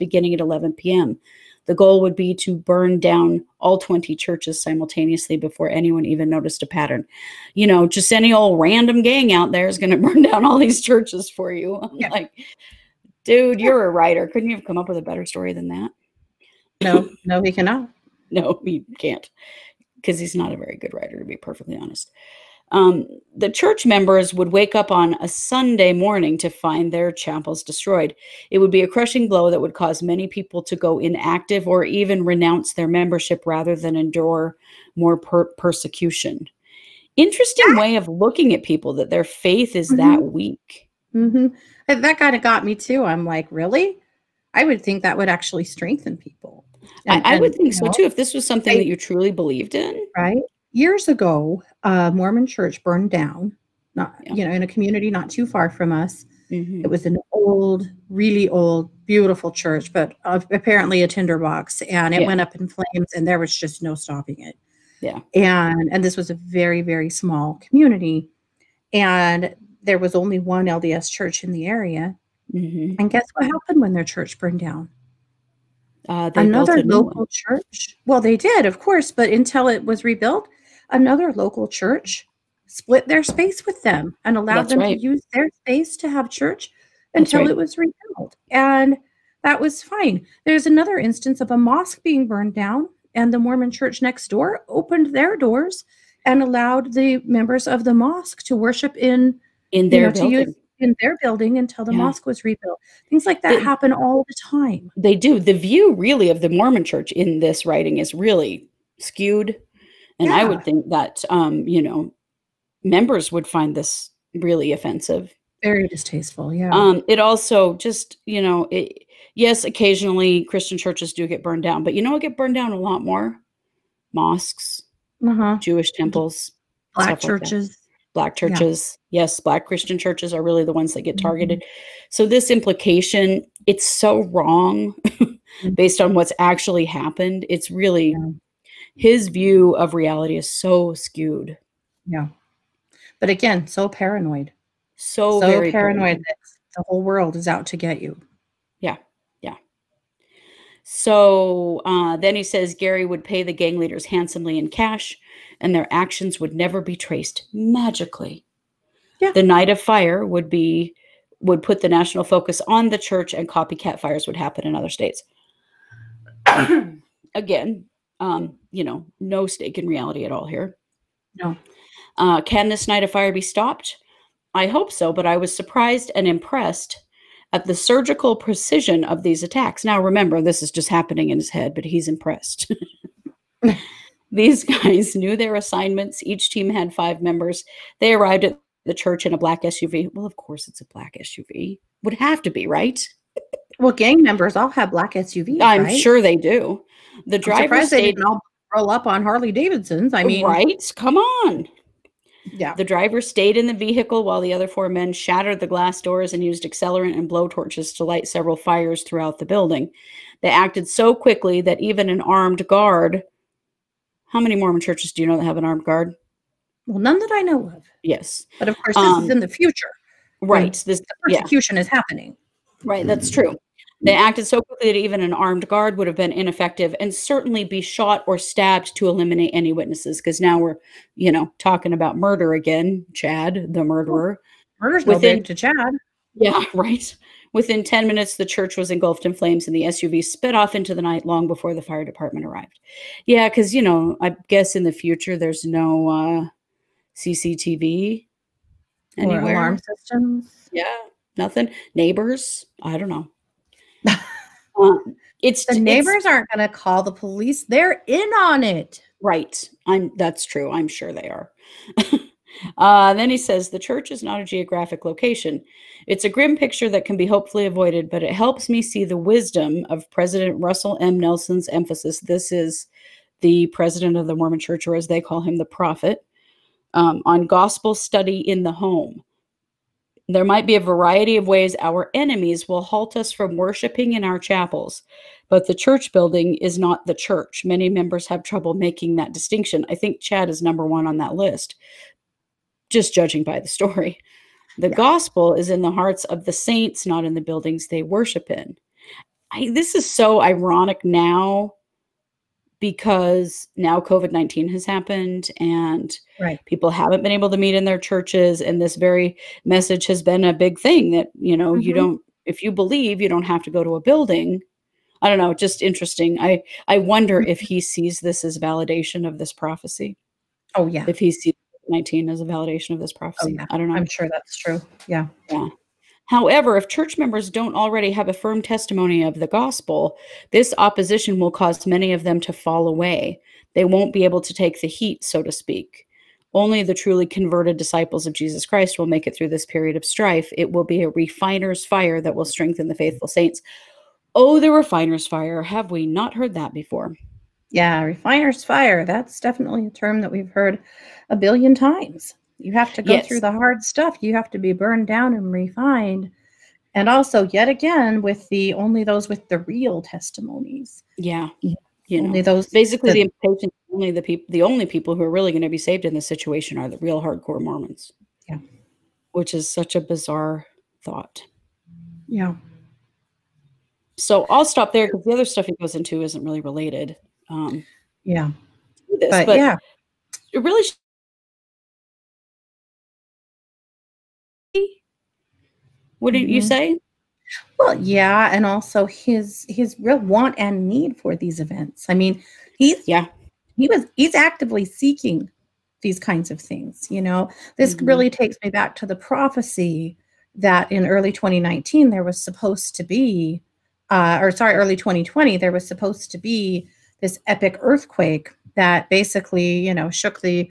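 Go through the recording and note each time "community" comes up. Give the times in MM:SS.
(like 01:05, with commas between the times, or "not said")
00:54, 01:07.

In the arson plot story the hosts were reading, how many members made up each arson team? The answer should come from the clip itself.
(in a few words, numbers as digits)
5.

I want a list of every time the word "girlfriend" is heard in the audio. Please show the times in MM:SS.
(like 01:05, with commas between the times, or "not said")
not said.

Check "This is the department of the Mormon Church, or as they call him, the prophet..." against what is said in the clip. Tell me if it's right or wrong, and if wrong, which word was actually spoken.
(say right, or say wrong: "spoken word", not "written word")
wrong: "president", not "department".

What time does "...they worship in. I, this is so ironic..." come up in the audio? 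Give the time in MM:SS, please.
04:57.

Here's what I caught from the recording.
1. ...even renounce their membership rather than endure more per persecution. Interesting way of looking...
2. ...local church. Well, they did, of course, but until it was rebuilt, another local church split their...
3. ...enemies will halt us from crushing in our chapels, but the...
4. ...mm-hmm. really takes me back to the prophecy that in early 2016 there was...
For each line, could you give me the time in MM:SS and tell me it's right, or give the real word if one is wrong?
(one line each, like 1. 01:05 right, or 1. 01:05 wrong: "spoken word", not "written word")
1. 00:31 right
2. 01:16 right
3. 04:42 wrong: "worshiping", not "crushing"
4. 06:37 wrong: "2019", not "2016".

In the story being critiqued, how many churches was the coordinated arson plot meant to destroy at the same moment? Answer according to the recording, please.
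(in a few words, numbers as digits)
20.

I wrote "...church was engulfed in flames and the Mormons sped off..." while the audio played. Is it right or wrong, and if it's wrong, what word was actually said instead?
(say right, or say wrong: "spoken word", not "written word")
wrong: "SUV", not "Mormons".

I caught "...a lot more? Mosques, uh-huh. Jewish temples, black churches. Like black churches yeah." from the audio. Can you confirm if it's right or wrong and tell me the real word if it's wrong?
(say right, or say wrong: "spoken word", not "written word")
right.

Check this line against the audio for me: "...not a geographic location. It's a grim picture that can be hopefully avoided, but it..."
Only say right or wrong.
right.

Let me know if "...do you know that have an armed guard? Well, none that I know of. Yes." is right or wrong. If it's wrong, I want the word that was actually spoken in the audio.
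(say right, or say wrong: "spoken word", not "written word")
right.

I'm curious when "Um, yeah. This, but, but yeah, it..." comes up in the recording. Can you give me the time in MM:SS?
06:17.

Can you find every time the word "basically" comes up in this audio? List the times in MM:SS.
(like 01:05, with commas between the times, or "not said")
06:02, 06:49.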